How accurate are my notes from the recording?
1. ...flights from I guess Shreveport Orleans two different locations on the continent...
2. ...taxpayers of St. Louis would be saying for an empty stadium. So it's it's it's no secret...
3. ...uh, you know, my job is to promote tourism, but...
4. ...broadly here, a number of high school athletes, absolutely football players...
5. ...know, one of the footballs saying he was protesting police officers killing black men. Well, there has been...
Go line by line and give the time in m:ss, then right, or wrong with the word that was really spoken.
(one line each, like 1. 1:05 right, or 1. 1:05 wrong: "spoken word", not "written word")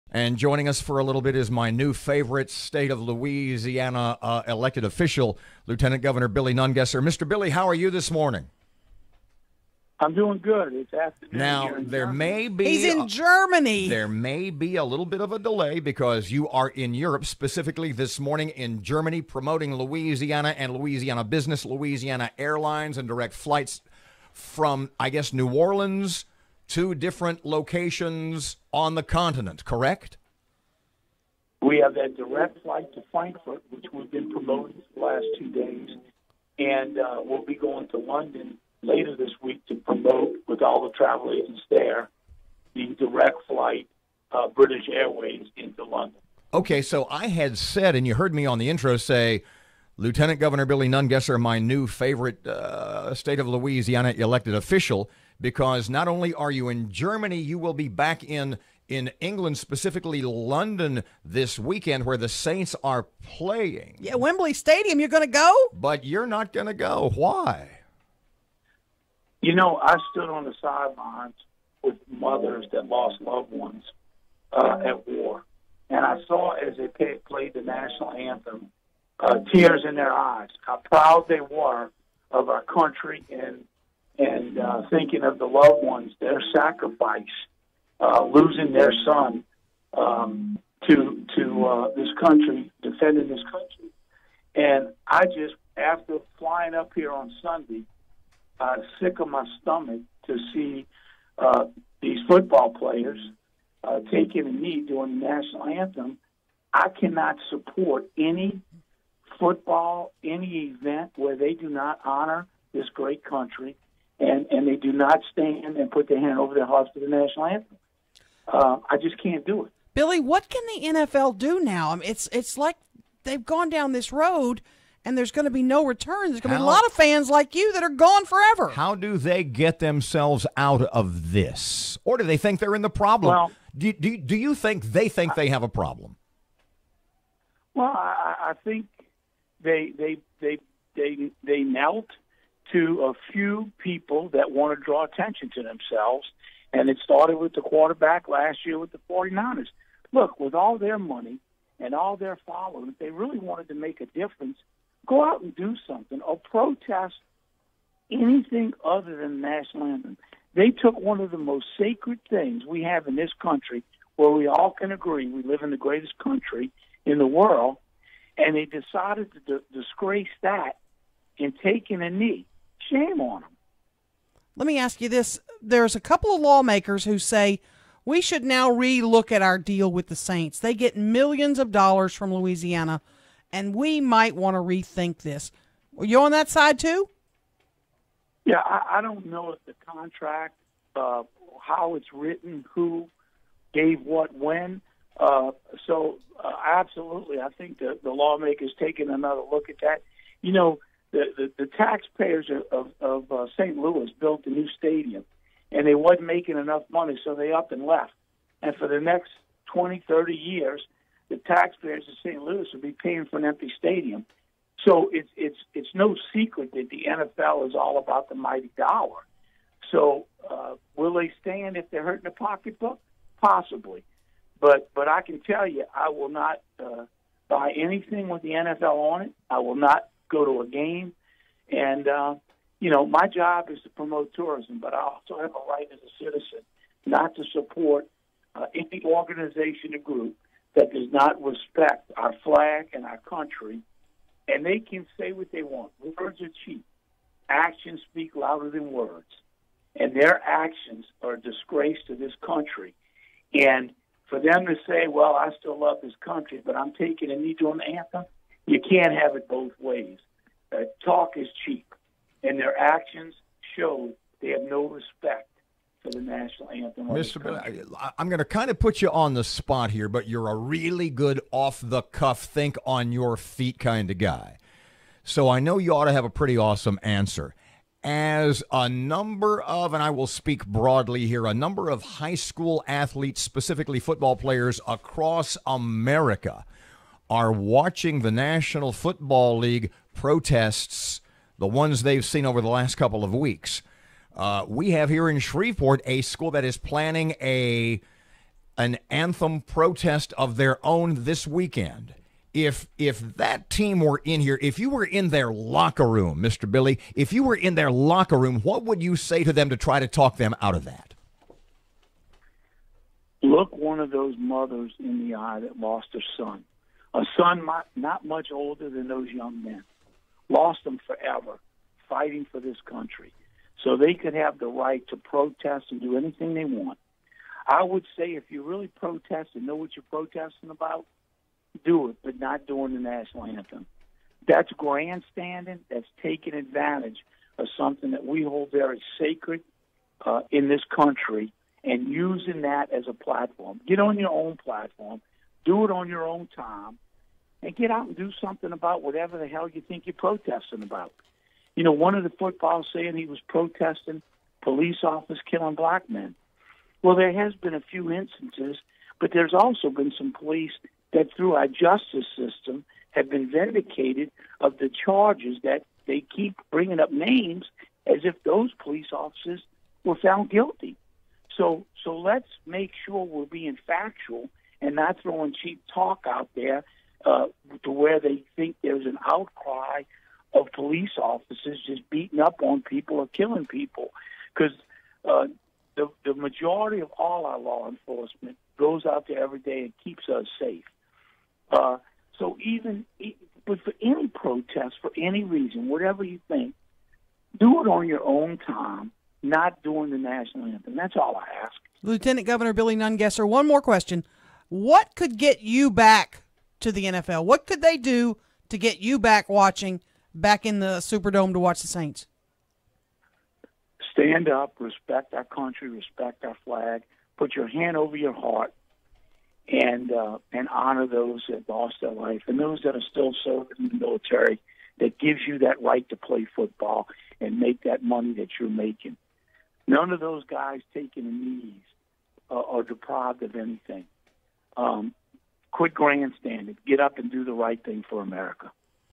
1. 0:23 wrong: "New", not "Shreveport"
2. 3:31 wrong: "paying", not "saying"
3. 3:52 right
4. 4:40 wrong: "specifically", not "absolutely"
5. 5:51 right.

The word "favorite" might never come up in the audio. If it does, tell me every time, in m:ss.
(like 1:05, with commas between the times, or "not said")
0:01, 0:51.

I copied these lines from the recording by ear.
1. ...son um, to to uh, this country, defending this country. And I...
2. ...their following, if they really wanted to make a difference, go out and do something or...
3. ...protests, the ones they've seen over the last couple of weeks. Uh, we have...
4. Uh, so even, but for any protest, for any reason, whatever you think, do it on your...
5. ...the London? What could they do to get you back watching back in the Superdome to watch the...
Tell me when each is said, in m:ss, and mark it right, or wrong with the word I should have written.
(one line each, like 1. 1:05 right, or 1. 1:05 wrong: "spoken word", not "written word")
1. 1:29 right
2. 2:32 right
3. 4:50 right
4. 6:31 right
5. 6:46 wrong: "NFL", not "London".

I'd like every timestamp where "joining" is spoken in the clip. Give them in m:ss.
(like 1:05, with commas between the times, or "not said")
0:00.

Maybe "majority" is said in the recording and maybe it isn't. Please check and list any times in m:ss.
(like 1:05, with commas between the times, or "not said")
6:26.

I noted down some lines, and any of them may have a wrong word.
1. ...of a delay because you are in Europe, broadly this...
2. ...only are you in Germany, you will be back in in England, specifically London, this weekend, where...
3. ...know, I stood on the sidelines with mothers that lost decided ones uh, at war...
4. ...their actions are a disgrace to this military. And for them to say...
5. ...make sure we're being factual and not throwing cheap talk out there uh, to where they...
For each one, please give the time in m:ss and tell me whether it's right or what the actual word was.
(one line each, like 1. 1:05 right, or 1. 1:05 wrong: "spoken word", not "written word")
1. 0:15 wrong: "specifically", not "broadly"
2. 0:56 right
3. 1:09 wrong: "loved", not "decided"
4. 4:10 wrong: "country", not "military"
5. 6:12 right.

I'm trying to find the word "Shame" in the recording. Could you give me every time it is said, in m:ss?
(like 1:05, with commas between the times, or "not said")
2:52.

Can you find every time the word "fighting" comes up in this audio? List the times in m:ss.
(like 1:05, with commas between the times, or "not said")
5:22.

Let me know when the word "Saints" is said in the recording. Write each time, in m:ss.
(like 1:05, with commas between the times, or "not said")
1:02, 3:00, 6:51.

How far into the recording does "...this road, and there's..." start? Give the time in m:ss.
2:03.